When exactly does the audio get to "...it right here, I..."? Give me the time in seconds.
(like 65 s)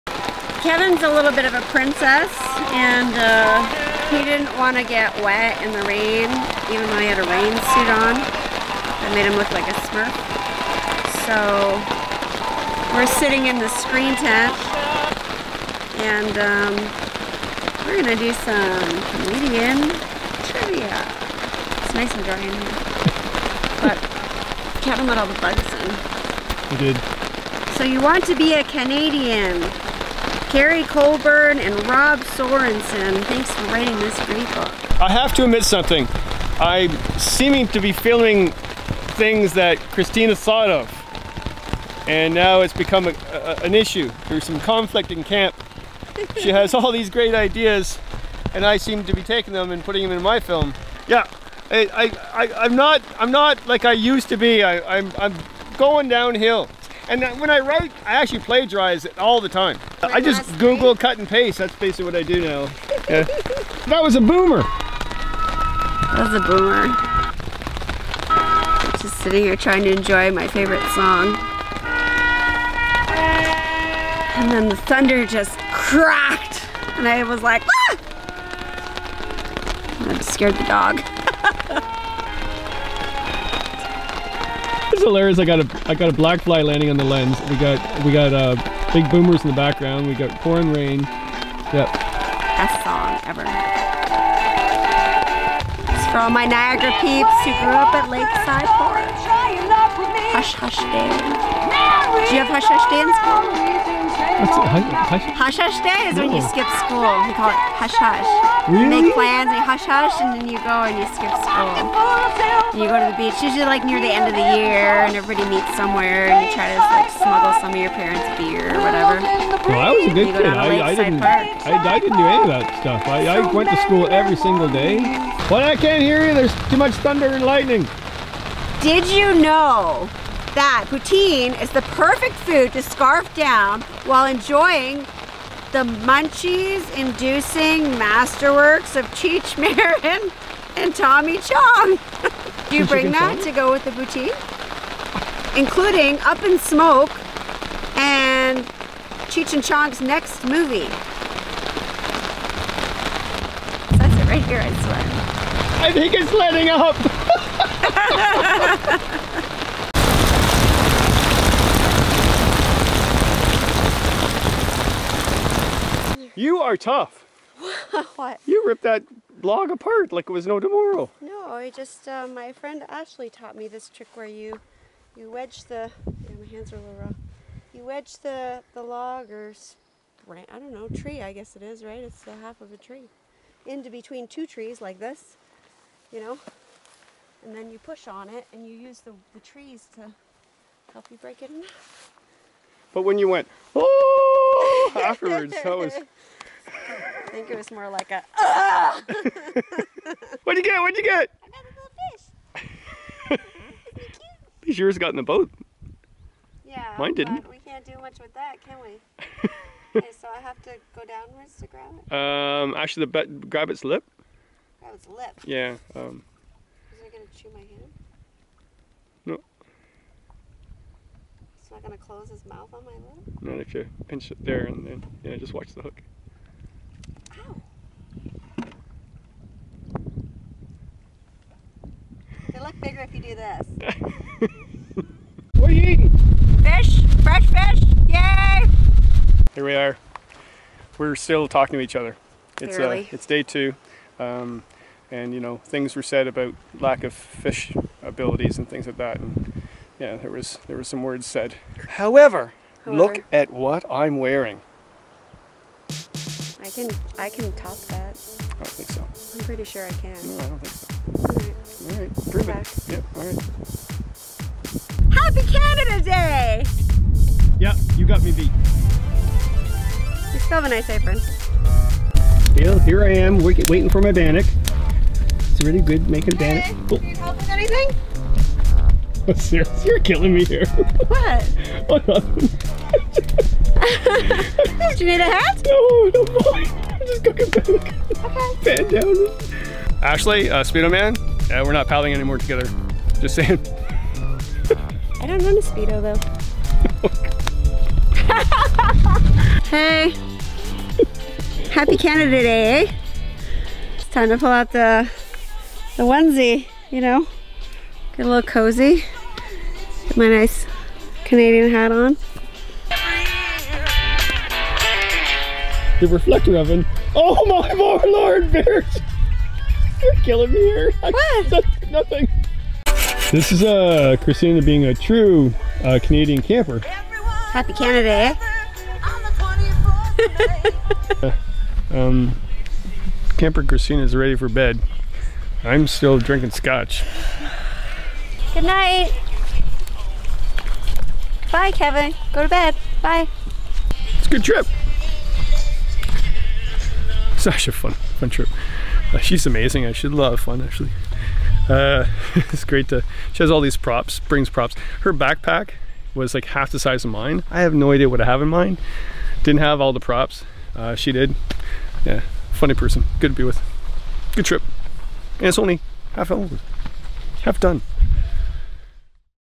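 154 s.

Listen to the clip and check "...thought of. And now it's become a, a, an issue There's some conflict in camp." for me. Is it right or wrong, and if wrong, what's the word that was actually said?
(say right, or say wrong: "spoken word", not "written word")
right.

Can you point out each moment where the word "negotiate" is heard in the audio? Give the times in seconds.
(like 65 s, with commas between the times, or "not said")
not said.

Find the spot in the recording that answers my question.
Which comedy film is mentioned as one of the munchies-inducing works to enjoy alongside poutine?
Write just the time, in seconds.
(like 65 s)
146 s.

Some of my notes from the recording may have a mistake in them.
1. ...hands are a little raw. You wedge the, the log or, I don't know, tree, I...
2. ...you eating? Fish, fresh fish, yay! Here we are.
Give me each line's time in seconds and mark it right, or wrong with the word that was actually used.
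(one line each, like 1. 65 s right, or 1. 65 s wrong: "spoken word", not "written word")
1. 176 s right
2. 235 s right.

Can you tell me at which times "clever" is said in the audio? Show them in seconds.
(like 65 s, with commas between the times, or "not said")
not said.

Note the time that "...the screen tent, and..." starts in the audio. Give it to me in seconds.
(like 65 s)
13 s.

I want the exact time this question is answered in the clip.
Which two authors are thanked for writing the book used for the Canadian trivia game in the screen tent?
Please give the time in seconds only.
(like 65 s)
30 s.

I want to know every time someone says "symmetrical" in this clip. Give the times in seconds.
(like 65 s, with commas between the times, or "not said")
not said.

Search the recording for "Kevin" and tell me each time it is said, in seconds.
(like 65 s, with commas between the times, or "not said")
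0 s, 24 s, 341 s.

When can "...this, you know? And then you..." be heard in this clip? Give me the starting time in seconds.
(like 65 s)
184 s.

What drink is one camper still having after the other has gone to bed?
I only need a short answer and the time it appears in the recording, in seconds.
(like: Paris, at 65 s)
scotch, at 336 s.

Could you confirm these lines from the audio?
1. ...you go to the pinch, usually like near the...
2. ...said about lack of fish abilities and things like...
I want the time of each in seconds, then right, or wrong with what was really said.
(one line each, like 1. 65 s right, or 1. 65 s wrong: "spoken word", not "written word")
1. 112 s wrong: "beach", not "pinch"
2. 246 s right.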